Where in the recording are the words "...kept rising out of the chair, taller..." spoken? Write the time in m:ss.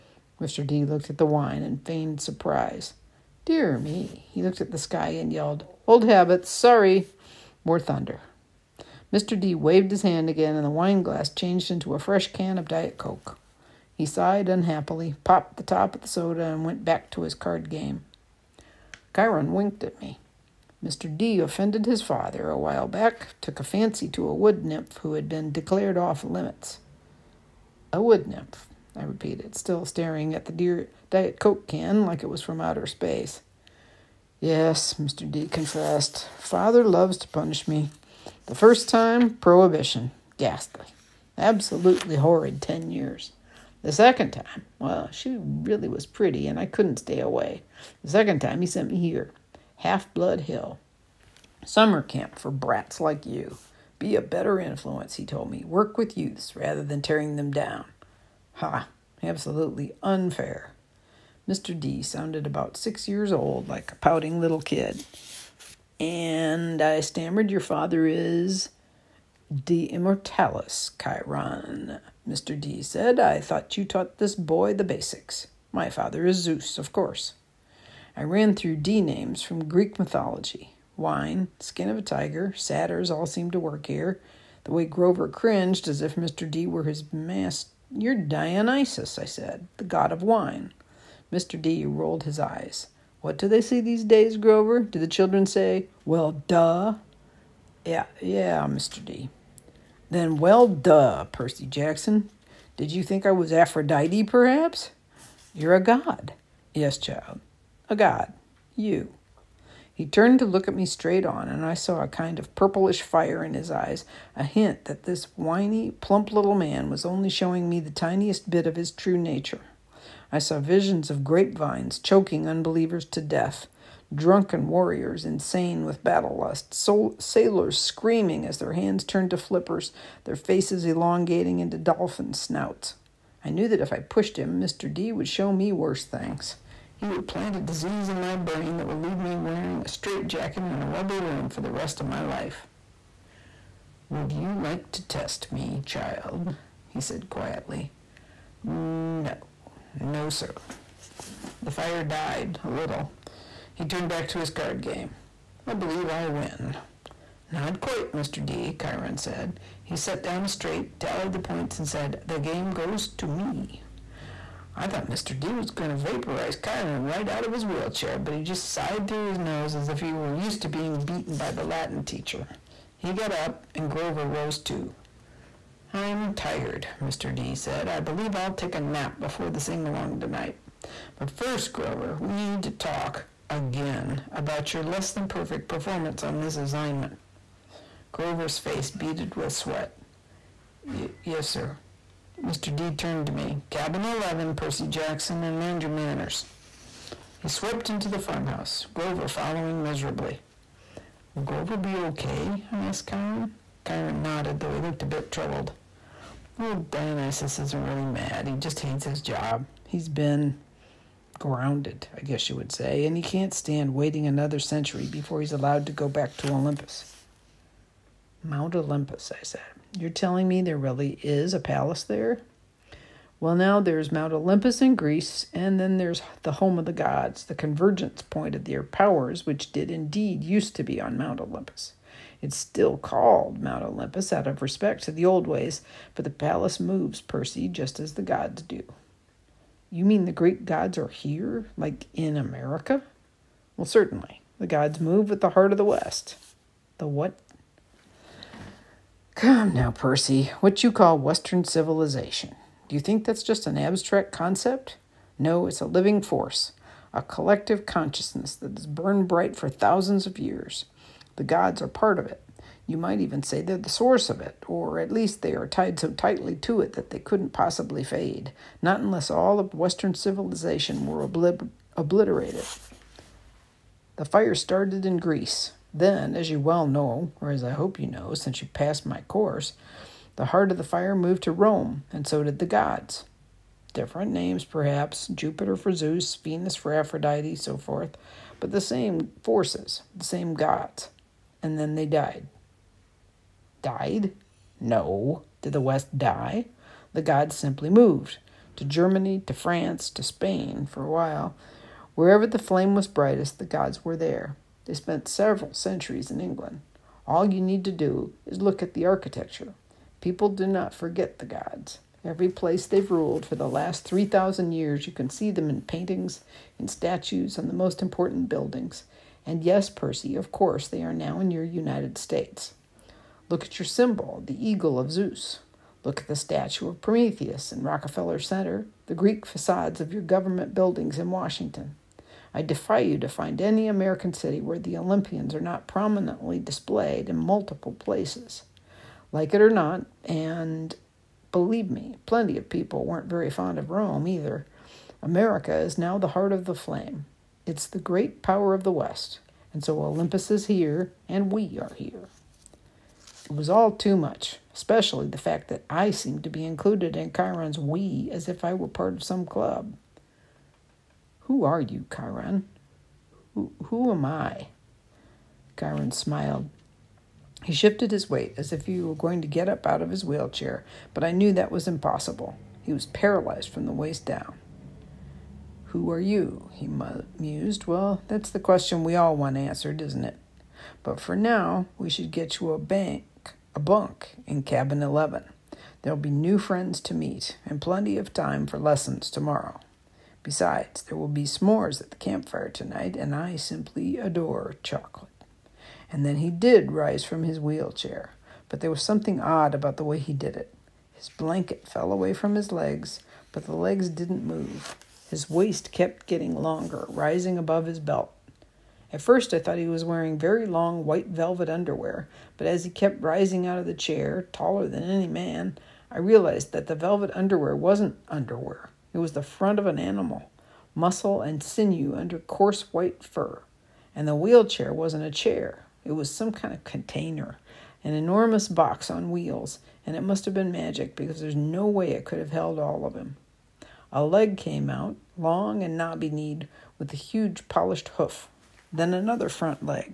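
6:52.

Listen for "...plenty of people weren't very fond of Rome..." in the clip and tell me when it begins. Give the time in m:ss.
5:42.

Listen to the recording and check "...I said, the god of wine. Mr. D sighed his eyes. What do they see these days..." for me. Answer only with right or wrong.
wrong.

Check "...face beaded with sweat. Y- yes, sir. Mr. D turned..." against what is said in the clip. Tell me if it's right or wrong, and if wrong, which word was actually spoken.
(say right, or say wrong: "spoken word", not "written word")
right.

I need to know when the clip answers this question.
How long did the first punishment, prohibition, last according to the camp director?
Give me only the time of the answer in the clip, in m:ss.
0:42.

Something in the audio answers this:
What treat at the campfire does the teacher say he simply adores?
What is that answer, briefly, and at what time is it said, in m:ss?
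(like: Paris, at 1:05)
chocolate, at 6:34.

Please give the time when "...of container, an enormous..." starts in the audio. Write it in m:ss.
7:06.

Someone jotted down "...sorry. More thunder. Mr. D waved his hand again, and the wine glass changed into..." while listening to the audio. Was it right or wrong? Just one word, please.
right.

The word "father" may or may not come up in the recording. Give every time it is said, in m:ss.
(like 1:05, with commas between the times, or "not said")
0:22, 0:36, 1:07, 1:15.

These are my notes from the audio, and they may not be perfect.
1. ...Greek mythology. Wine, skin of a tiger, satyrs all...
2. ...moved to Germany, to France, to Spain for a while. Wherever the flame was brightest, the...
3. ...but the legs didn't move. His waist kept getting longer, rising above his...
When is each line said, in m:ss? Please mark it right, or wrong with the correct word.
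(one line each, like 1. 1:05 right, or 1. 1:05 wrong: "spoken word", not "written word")
1. 1:19 right
2. 4:57 right
3. 6:43 right.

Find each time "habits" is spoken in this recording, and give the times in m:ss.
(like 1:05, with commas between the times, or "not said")
0:06.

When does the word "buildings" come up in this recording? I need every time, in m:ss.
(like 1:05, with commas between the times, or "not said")
5:18, 5:30.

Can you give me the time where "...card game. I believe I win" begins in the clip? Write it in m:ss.
2:34.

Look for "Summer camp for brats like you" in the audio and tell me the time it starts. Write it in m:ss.
0:51.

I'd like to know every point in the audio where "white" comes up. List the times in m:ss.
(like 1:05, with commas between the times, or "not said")
6:51, 7:02.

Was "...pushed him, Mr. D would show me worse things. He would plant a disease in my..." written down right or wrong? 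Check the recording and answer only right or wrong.
right.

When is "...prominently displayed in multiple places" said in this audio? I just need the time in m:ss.
5:35.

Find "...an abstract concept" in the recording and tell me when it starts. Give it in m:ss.
4:13.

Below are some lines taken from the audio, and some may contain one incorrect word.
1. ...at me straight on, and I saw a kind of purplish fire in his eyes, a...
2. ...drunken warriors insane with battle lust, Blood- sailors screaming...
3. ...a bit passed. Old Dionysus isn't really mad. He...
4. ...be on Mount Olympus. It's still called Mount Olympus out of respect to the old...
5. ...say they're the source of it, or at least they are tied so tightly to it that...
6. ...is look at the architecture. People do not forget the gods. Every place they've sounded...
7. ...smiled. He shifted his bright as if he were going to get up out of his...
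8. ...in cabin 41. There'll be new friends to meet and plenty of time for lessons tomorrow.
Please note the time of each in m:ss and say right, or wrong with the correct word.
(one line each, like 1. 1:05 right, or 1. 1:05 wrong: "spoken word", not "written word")
1. 1:50 right
2. 2:04 wrong: "Sol", not "Blood"
3. 3:25 wrong: "troubled", not "passed"
4. 3:50 right
5. 4:23 right
6. 5:08 wrong: "ruled", not "sounded"
7. 6:06 wrong: "weight", not "bright"
8. 6:24 wrong: "11", not "41".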